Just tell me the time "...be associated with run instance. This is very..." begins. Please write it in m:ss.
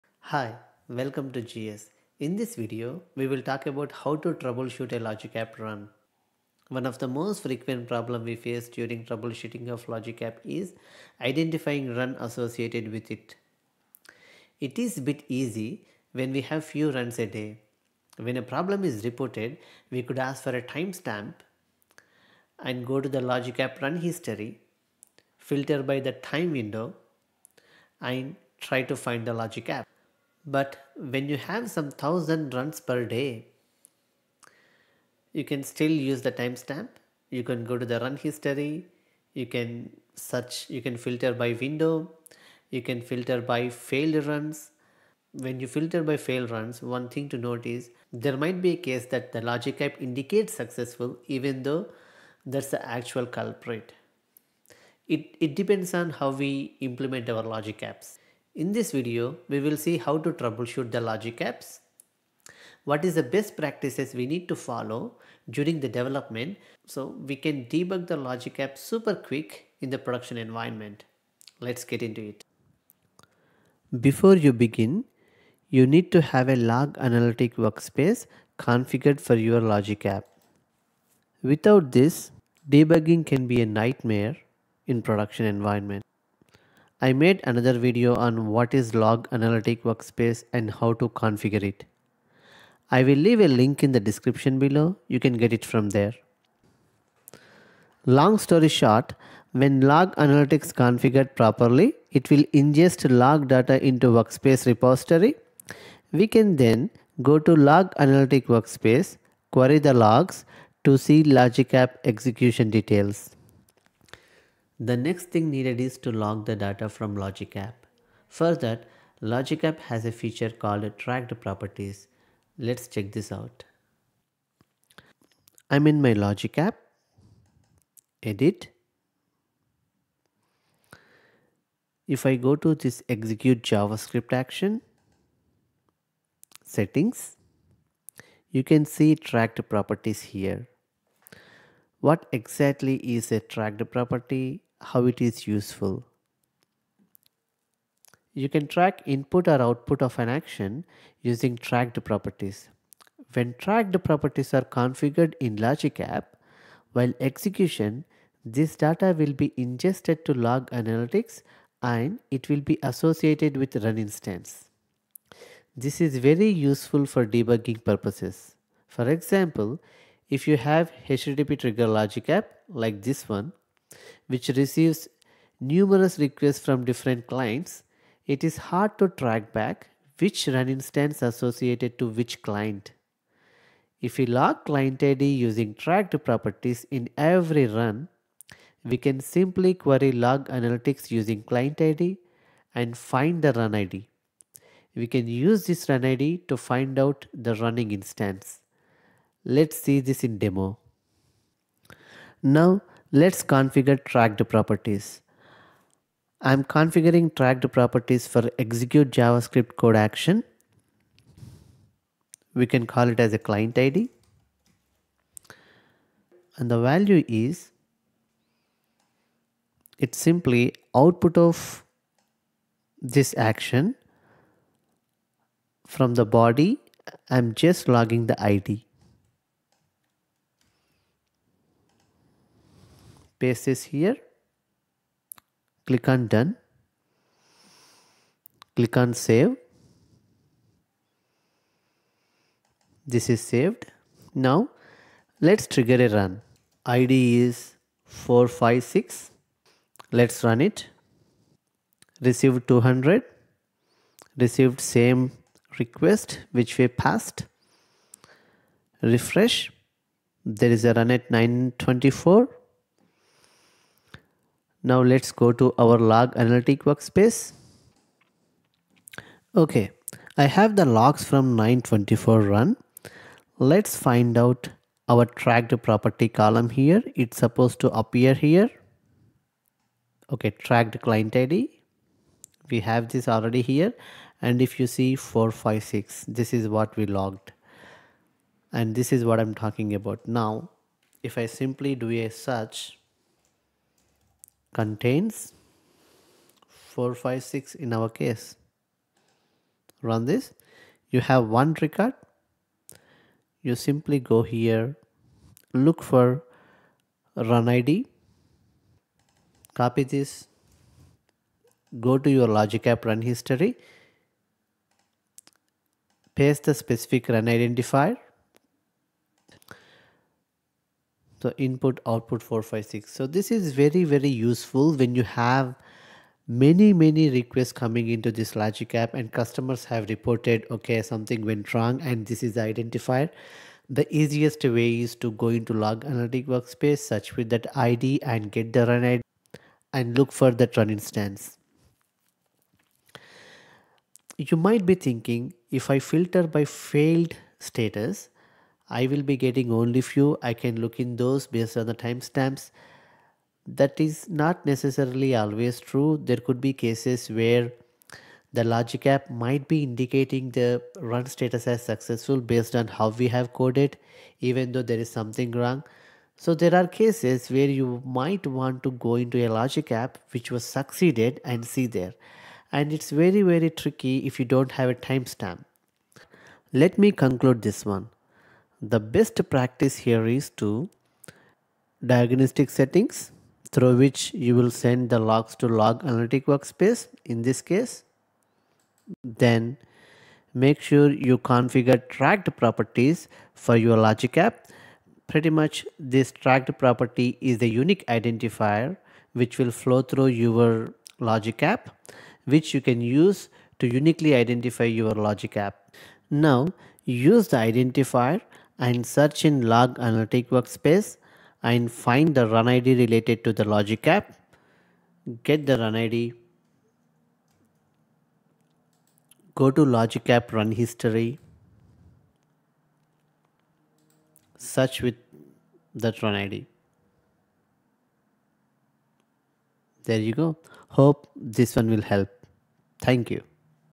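2:42.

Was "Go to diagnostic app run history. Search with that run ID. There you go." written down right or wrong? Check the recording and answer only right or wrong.
wrong.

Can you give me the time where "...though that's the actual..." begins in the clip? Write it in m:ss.
0:51.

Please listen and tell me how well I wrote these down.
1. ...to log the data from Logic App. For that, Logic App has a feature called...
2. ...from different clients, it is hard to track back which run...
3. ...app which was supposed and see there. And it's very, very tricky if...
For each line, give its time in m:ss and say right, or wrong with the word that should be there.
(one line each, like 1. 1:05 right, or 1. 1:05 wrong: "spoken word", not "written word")
1. 1:55 right
2. 2:56 right
3. 6:09 wrong: "succeeded", not "supposed".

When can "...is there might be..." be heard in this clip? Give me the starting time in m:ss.
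0:47.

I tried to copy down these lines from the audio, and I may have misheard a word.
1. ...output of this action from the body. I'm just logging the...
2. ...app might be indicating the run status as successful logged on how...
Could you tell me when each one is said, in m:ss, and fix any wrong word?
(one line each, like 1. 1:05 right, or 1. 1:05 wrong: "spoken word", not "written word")
1. 3:40 right
2. 5:59 wrong: "based", not "logged".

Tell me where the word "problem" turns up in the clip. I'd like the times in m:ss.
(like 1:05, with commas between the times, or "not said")
0:07, 0:18.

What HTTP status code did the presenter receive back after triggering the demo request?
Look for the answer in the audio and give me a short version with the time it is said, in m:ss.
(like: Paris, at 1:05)
200, at 4:12.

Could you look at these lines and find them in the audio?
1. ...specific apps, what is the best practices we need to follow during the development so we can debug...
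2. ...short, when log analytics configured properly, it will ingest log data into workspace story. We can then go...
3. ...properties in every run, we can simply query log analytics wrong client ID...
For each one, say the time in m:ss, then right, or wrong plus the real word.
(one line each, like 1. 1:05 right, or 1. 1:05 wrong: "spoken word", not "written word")
1. 1:01 wrong: "logic", not "specific"
2. 1:38 wrong: "repository", not "story"
3. 3:06 wrong: "using", not "wrong".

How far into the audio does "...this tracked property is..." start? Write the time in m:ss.
6:35.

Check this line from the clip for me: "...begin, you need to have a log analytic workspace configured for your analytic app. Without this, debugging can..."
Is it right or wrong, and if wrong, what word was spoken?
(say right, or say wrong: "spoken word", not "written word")
wrong: "logic", not "analytic".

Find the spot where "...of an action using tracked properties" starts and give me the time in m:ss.
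2:30.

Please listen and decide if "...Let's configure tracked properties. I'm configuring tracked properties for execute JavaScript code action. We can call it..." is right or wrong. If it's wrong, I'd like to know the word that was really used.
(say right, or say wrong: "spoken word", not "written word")
right.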